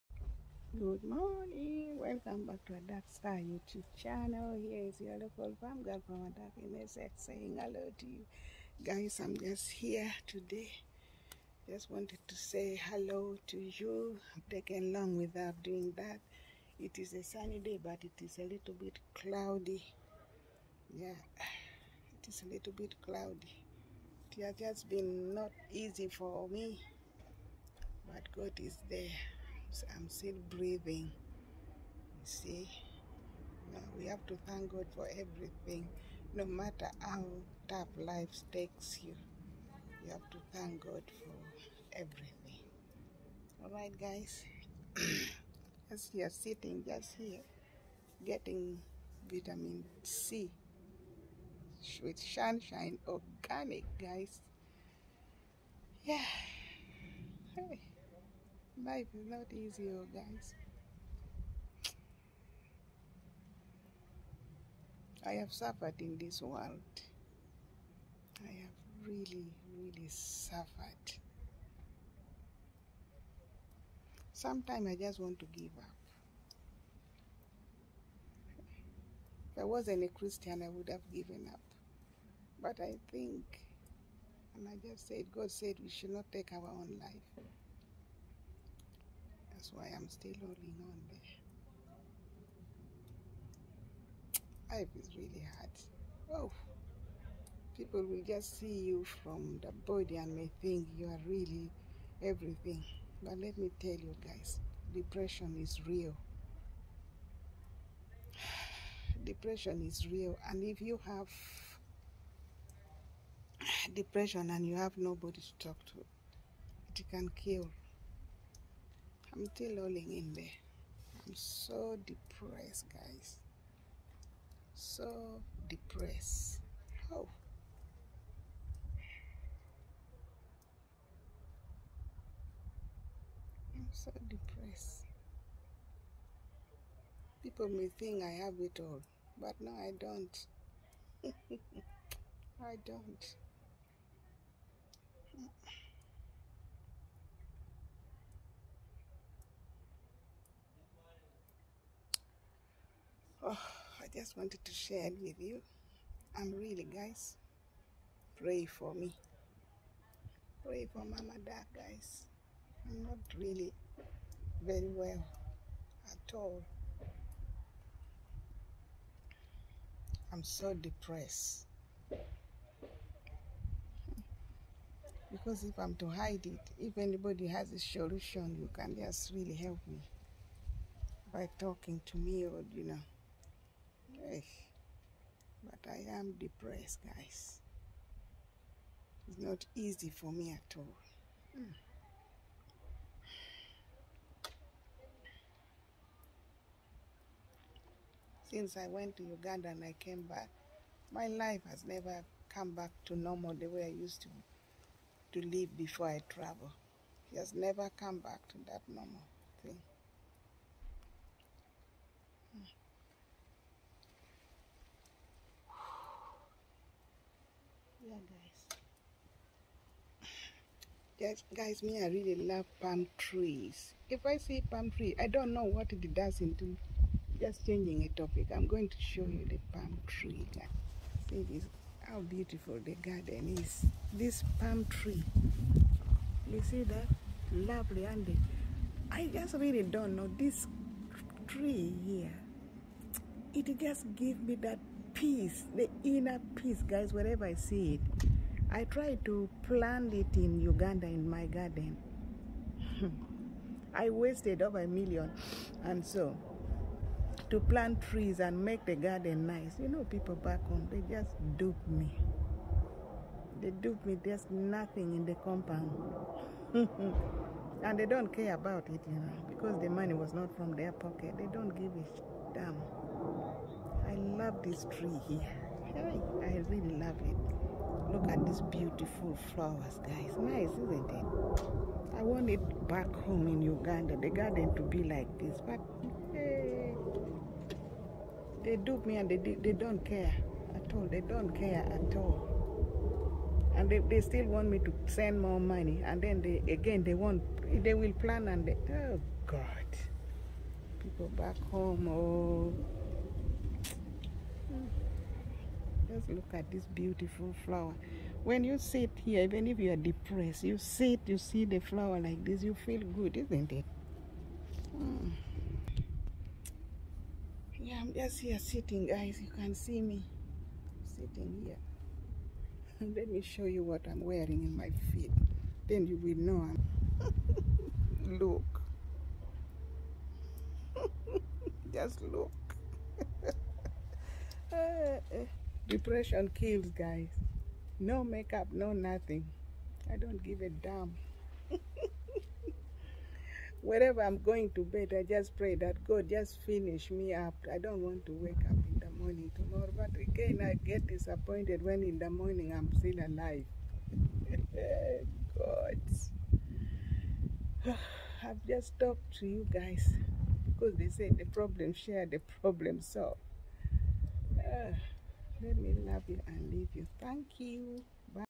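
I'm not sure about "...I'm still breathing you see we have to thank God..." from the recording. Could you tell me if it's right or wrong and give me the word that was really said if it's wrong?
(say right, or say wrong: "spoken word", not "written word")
right.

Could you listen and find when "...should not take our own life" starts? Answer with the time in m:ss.
1:25.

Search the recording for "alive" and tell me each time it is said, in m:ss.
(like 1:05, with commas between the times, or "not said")
5:53.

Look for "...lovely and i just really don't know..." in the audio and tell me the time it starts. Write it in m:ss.
3:57.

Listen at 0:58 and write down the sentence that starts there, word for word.
Life is not easy, oh, guys.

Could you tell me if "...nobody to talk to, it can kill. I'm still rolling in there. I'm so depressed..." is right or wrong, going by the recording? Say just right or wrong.
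right.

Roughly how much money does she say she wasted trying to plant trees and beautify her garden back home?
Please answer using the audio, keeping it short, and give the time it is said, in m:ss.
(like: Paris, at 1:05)
over a million, at 4:14.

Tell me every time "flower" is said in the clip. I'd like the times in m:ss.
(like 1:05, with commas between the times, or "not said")
4:39, 5:07, 5:11.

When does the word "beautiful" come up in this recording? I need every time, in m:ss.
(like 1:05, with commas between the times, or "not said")
3:52, 4:38, 5:06.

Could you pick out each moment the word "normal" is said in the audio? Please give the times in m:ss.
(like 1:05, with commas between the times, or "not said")
3:23, 3:28.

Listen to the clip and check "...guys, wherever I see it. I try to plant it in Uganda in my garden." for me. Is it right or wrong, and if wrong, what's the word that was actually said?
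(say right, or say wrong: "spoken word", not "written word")
right.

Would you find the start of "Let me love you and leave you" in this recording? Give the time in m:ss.
6:05.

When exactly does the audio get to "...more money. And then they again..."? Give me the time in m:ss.
4:55.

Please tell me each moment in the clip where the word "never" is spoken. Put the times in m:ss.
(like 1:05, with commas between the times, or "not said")
3:21, 3:27.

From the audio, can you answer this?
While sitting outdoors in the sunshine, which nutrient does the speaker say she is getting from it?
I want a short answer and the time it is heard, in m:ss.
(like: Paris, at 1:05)
vitamin C, at 0:49.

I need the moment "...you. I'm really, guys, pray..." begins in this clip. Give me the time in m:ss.
2:35.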